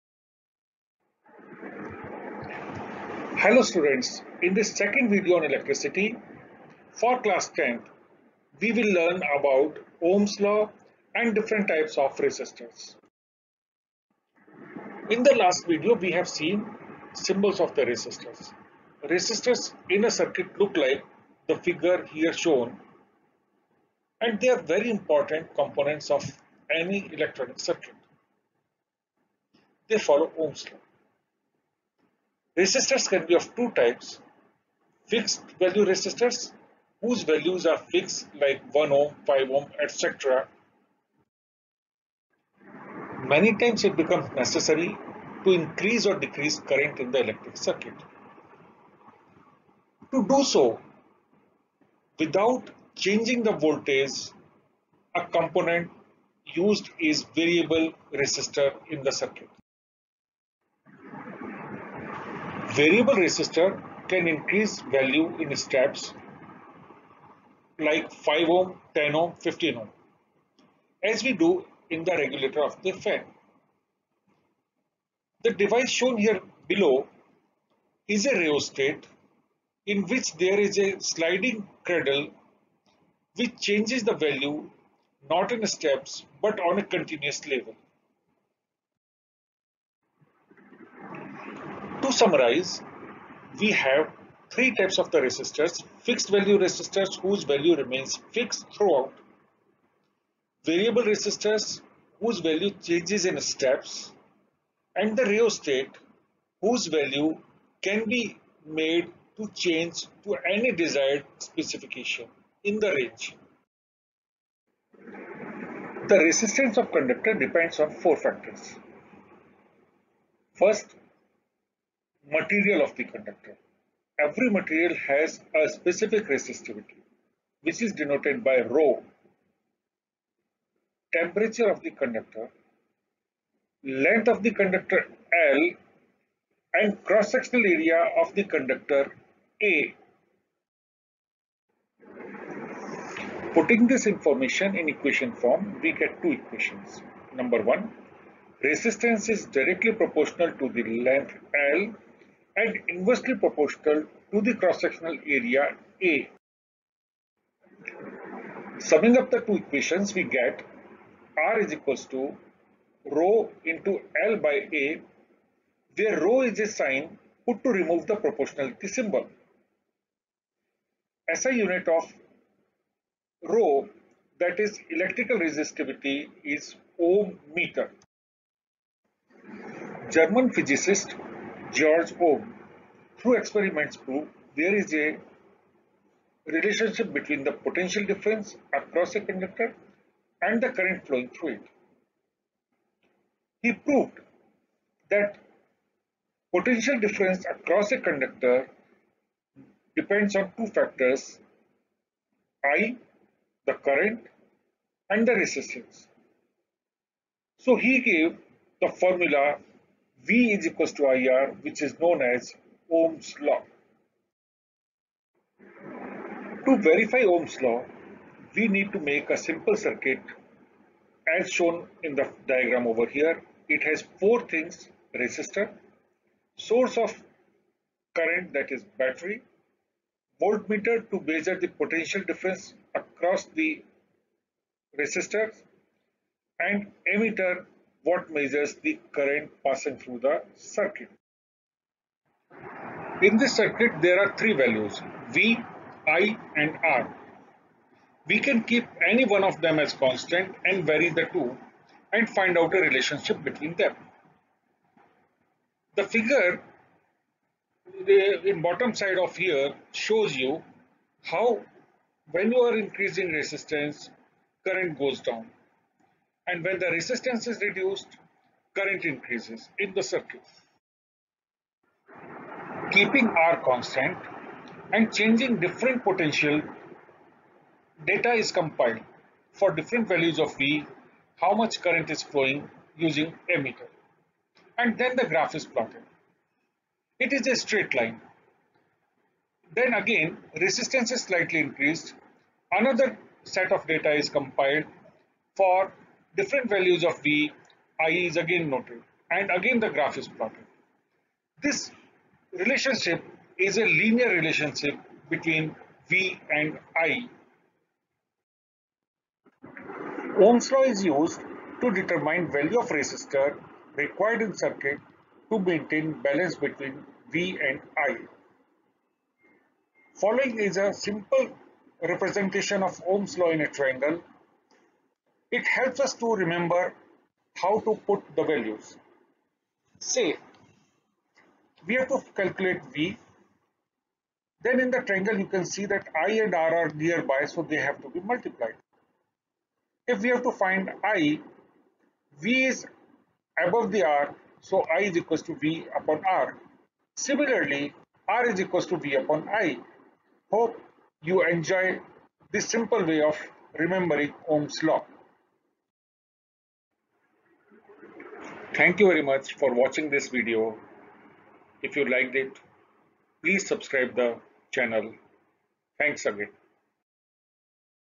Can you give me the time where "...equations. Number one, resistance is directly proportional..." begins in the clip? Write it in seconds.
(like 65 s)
146 s.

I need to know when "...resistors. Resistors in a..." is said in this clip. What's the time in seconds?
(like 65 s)
17 s.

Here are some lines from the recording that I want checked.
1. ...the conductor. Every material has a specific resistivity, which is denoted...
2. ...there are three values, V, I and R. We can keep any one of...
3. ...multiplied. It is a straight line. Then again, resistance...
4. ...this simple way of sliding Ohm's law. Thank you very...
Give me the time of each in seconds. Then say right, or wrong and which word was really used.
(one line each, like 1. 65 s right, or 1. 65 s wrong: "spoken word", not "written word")
1. 122 s right
2. 244 s right
3. 285 s wrong: "plotted", not "multiplied"
4. 352 s wrong: "remembering", not "sliding".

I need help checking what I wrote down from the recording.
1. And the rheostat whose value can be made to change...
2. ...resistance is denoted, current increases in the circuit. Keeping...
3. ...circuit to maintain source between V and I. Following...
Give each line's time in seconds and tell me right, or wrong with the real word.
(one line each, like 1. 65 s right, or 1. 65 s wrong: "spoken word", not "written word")
1. 104 s right
2. 266 s wrong: "reduced", not "denoted"
3. 314 s wrong: "balance", not "source".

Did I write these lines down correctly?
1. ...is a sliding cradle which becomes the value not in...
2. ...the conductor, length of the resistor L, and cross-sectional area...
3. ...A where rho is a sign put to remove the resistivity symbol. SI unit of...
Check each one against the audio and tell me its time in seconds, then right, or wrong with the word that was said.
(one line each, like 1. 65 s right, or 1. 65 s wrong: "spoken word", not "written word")
1. 80 s wrong: "changes", not "becomes"
2. 131 s wrong: "conductor", not "resistor"
3. 164 s wrong: "proportionality", not "resistivity".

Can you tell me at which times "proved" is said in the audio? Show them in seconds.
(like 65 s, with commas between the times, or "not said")
183 s, 193 s.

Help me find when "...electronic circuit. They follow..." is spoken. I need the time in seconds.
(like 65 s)
27 s.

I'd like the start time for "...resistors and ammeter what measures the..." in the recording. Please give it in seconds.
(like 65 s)
234 s.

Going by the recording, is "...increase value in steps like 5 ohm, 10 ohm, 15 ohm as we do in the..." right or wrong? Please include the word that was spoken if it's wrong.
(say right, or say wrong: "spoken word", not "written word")
right.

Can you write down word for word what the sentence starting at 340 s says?
If we have to find I, V is above the R, so I is equal to V upon R.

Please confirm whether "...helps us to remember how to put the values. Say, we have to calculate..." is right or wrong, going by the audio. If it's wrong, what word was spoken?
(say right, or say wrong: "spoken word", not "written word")
right.